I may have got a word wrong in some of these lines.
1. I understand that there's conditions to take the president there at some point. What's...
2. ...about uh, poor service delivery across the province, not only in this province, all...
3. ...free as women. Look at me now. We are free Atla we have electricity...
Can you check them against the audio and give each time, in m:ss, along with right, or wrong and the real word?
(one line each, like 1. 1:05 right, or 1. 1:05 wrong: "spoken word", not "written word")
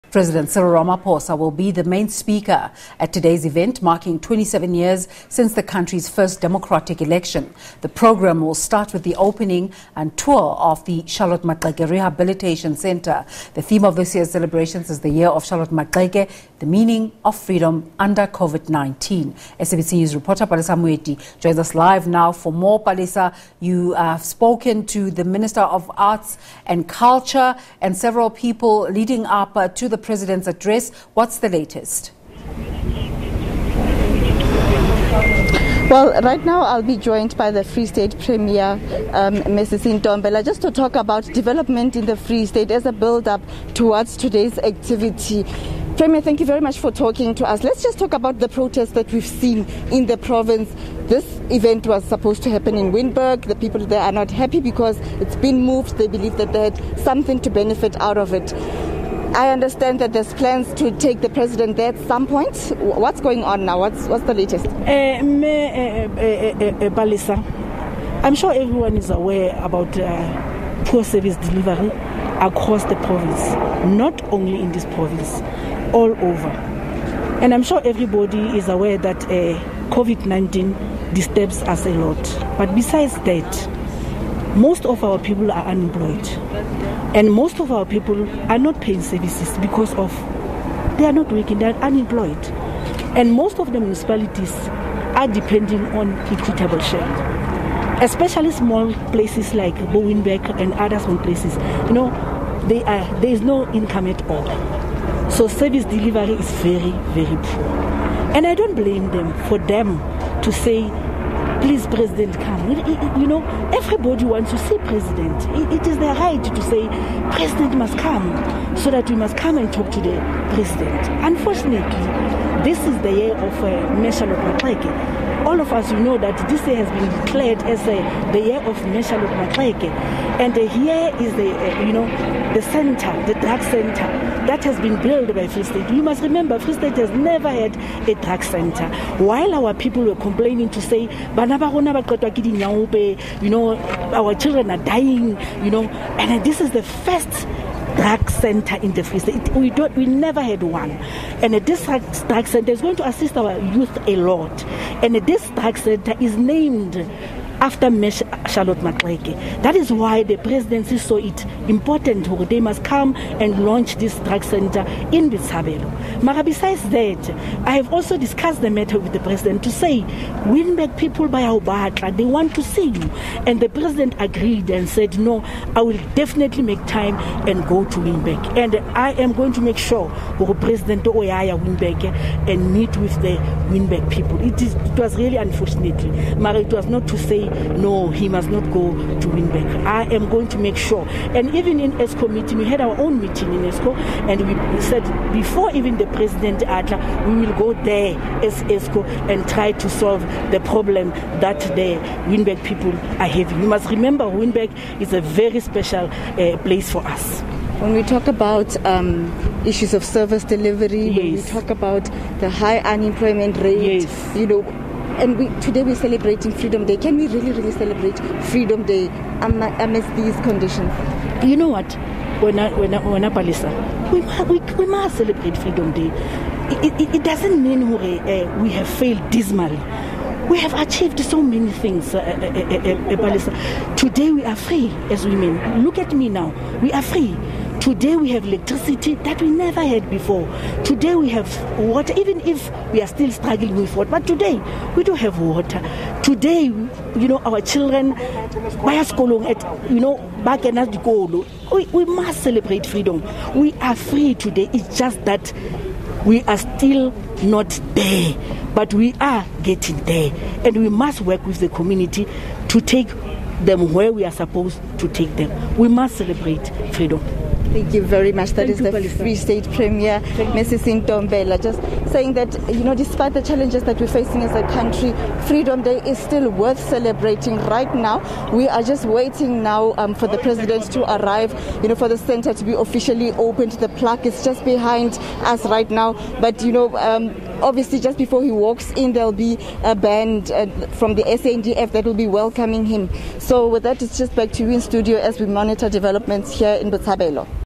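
1. 0:59 wrong: "plans", not "conditions"
2. 1:09 right
3. 3:54 wrong: "Today", not "Atla".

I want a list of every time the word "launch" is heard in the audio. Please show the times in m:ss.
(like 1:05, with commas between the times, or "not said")
2:43.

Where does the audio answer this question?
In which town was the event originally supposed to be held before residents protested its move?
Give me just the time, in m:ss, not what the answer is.
0:52.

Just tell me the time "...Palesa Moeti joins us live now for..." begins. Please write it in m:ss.
0:20.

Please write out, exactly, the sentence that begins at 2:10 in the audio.
And uh, here is the, uh, you know, the center, the drug center that has been built by Free State.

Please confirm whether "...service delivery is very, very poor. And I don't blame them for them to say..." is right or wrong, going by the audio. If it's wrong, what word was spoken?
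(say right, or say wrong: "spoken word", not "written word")
right.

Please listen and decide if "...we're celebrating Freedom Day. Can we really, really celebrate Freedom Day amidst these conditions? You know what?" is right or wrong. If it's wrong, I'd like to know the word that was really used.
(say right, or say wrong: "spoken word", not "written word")
right.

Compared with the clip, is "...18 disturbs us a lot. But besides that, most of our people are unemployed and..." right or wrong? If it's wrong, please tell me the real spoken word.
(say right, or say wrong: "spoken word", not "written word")
wrong: "19", not "18".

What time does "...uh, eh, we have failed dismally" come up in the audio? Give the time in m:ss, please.
3:48.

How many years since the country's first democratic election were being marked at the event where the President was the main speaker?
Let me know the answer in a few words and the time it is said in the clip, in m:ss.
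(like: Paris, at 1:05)
27, at 0:04.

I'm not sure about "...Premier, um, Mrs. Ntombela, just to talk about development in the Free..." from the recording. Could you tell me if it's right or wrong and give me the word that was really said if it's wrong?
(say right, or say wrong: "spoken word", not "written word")
right.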